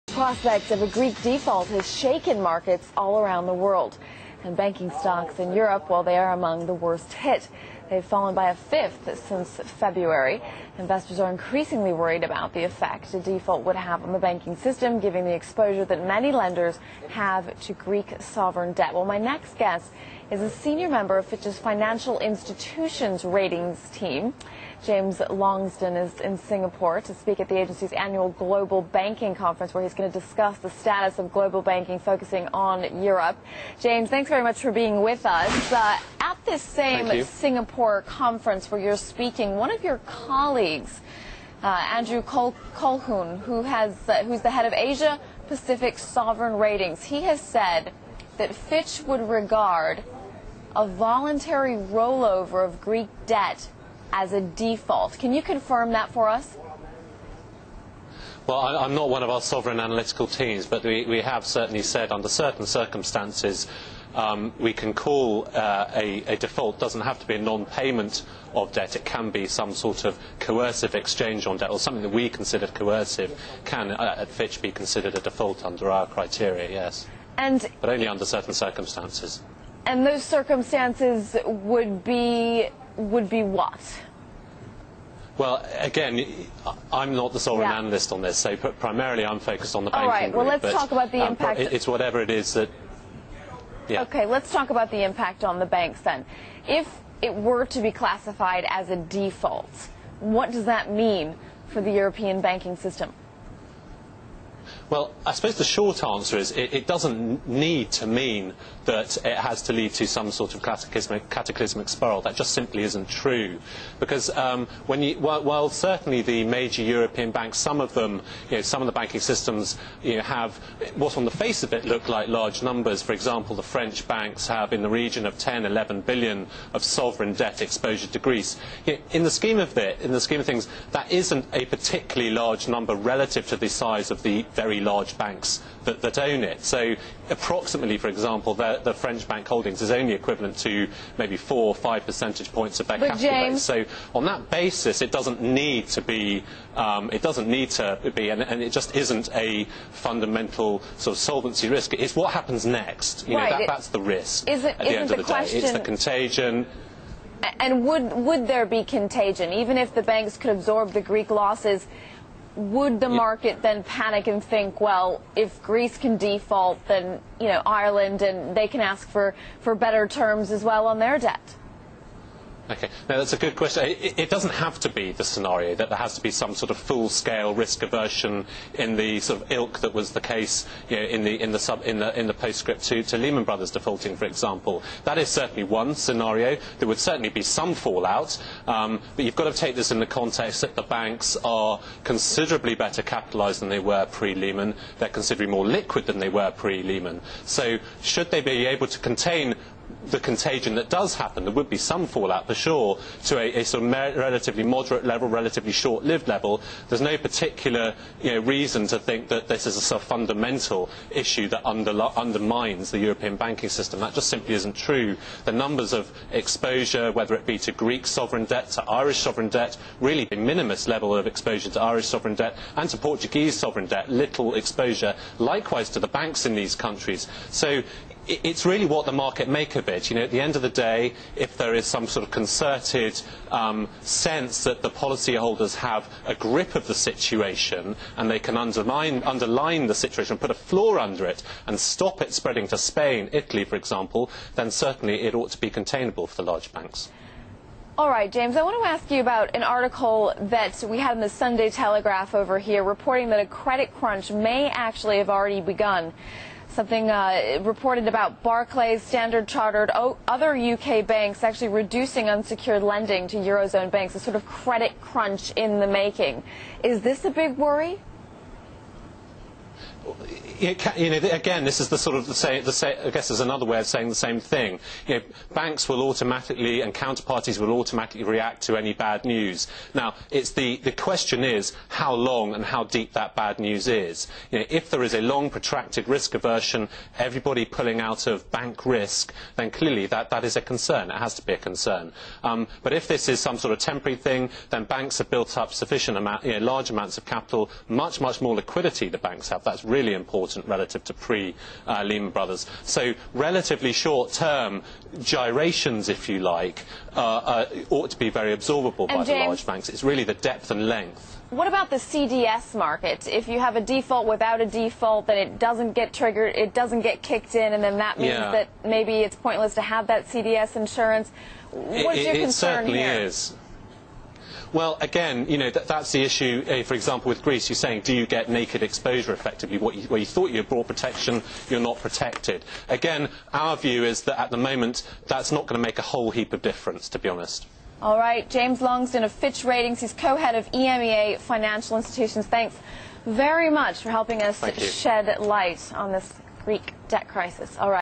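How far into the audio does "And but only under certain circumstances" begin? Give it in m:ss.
1:17.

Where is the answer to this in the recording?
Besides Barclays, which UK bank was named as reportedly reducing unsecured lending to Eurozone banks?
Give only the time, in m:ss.
4:19.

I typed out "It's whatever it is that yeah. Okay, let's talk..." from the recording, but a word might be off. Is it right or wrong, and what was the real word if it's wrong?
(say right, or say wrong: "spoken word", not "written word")
right.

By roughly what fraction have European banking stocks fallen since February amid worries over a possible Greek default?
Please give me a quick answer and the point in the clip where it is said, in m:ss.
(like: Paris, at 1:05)
a fifth, at 0:08.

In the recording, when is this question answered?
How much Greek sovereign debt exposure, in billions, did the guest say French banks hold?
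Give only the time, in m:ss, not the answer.
2:05.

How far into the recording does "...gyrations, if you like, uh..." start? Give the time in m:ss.
5:05.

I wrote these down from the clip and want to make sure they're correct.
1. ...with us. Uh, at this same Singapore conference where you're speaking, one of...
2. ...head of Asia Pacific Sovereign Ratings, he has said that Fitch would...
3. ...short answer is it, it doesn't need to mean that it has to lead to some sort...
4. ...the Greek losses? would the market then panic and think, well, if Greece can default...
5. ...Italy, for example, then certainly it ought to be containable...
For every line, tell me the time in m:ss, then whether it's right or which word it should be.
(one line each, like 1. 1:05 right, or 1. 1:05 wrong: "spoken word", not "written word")
1. 0:35 right
2. 0:44 right
3. 1:45 right
4. 2:40 right
5. 4:03 right.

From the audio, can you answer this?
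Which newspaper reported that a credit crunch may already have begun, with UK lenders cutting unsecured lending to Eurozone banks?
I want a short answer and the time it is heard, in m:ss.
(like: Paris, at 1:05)
Sunday Telegraph, at 4:11.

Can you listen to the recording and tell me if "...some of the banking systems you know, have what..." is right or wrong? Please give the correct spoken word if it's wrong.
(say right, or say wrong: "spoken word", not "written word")
right.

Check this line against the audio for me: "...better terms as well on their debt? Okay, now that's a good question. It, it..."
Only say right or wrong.
right.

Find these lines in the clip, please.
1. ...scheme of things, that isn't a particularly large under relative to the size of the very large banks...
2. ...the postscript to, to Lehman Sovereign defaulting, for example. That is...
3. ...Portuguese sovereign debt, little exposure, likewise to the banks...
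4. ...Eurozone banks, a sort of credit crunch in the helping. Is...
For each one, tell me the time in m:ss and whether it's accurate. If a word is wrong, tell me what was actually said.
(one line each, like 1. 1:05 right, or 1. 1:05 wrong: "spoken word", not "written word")
1. 2:10 wrong: "number", not "under"
2. 3:02 wrong: "Brothers", not "Sovereign"
3. 3:42 right
4. 4:23 wrong: "making", not "helping".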